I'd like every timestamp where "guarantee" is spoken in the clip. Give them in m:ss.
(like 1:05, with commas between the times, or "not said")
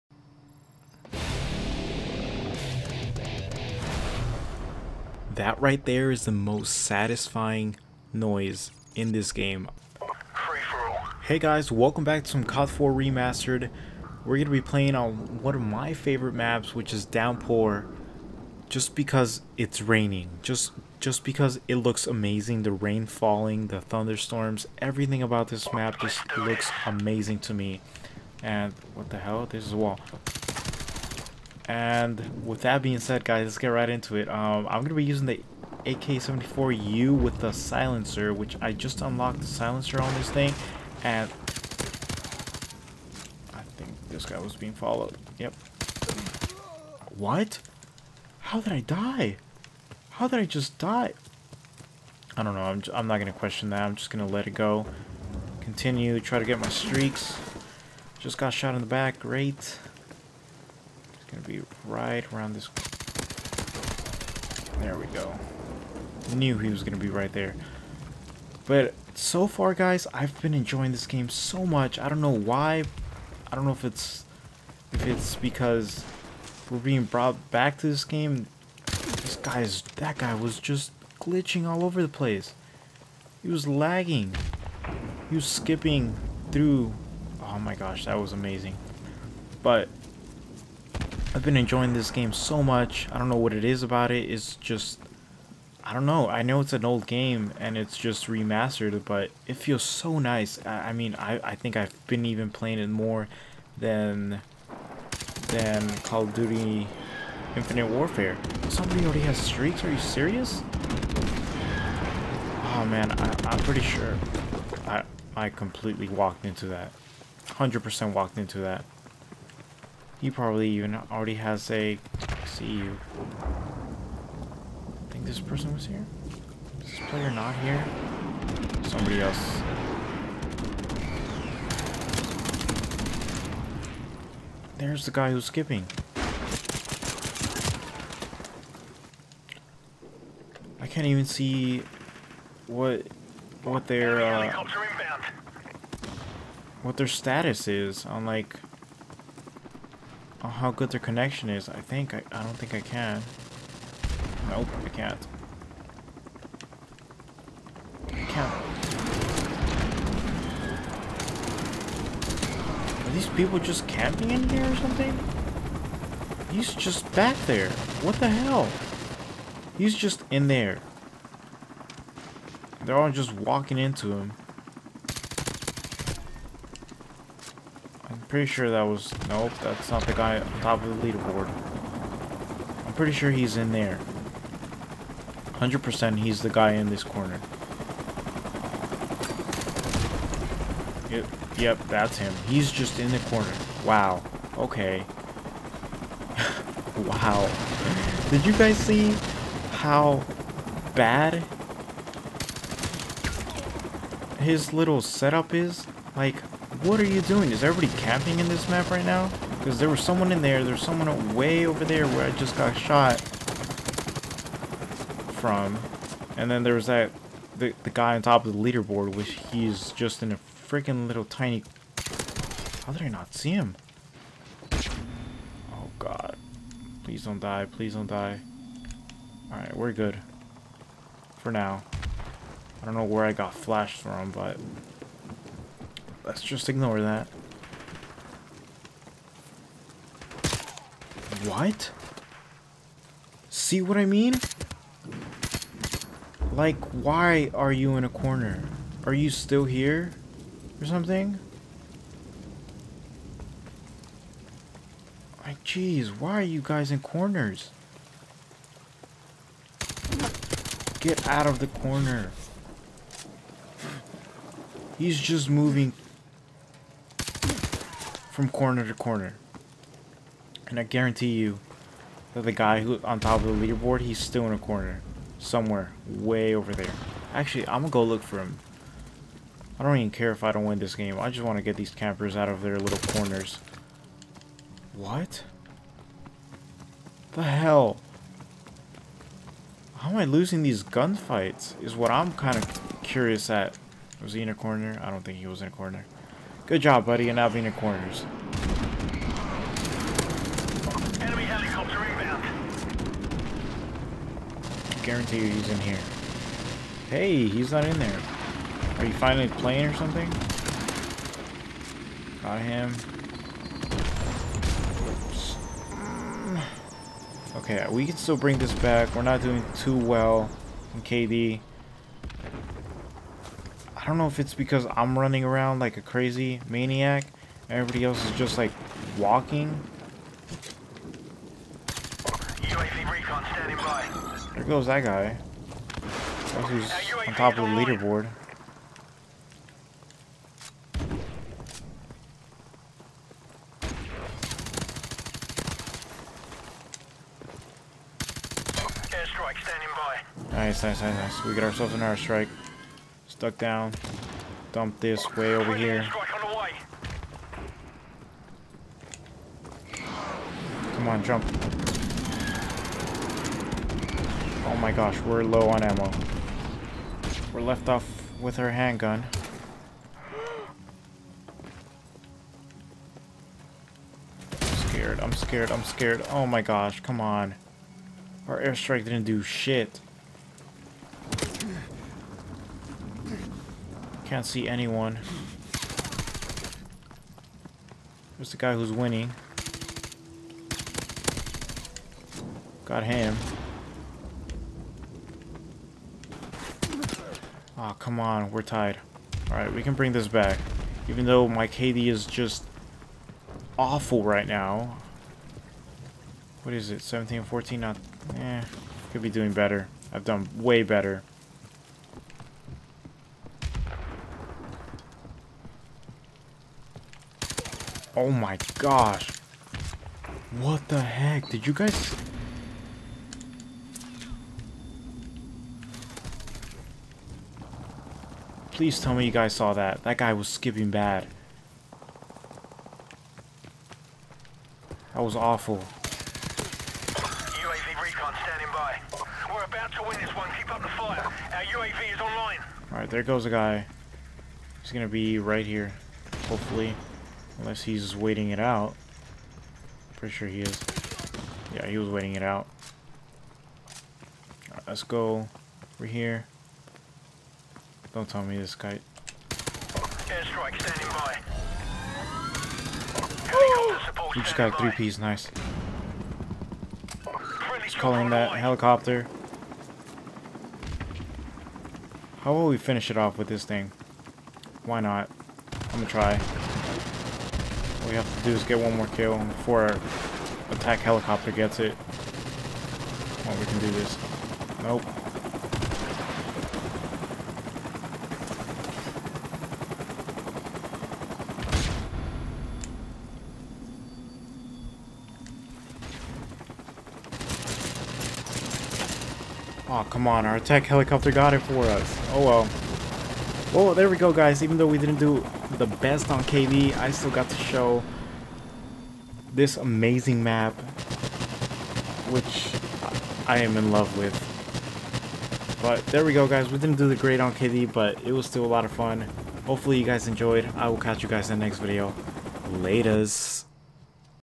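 4:30, 5:05.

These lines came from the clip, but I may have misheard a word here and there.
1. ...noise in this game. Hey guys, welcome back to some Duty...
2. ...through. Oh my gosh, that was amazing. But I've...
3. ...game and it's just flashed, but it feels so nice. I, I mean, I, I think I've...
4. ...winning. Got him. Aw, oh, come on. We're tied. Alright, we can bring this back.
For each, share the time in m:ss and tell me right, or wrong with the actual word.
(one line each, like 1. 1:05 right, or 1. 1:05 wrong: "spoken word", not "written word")
1. 0:08 wrong: "COD", not "Duty"
2. 1:26 right
3. 1:37 wrong: "remastered", not "flashed"
4. 6:28 right.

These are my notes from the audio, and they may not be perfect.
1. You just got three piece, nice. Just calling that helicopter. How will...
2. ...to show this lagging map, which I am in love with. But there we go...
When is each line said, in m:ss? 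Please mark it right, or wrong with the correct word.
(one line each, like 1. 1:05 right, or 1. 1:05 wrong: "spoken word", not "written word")
1. 7:44 right
2. 8:27 wrong: "amazing", not "lagging".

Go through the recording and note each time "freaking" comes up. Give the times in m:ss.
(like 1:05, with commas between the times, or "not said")
3:40.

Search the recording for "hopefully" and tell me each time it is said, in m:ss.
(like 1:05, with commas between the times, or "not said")
7:26, 8:39.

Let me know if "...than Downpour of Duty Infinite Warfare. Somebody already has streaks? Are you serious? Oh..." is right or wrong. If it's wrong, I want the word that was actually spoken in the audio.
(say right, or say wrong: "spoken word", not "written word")
wrong: "Call", not "Downpour".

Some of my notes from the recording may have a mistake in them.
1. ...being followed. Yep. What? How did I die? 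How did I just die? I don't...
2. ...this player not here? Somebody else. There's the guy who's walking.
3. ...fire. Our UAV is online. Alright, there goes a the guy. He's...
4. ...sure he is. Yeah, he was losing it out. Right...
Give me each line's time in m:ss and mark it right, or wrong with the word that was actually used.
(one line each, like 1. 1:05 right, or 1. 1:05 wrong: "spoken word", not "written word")
1. 0:44 right
2. 2:06 wrong: "skipping", not "walking"
3. 7:20 right
4. 7:30 wrong: "waiting", not "losing".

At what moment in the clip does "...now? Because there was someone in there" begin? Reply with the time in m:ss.
3:29.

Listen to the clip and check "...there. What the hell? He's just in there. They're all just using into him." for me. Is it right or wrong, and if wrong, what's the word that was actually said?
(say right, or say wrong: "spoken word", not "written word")
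wrong: "walking", not "using".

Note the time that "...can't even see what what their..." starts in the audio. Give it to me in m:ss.
2:20.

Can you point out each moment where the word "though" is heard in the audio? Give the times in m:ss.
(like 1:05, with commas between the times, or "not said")
6:41, 8:24.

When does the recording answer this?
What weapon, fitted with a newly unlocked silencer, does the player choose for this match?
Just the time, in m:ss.
0:35.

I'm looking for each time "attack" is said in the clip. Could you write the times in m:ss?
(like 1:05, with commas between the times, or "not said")
8:00, 8:20.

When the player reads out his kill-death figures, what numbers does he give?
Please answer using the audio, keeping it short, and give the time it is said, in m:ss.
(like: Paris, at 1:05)
17 14, at 6:47.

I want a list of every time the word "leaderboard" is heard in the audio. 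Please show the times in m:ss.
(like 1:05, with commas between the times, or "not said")
3:01, 3:38, 4:33, 5:37.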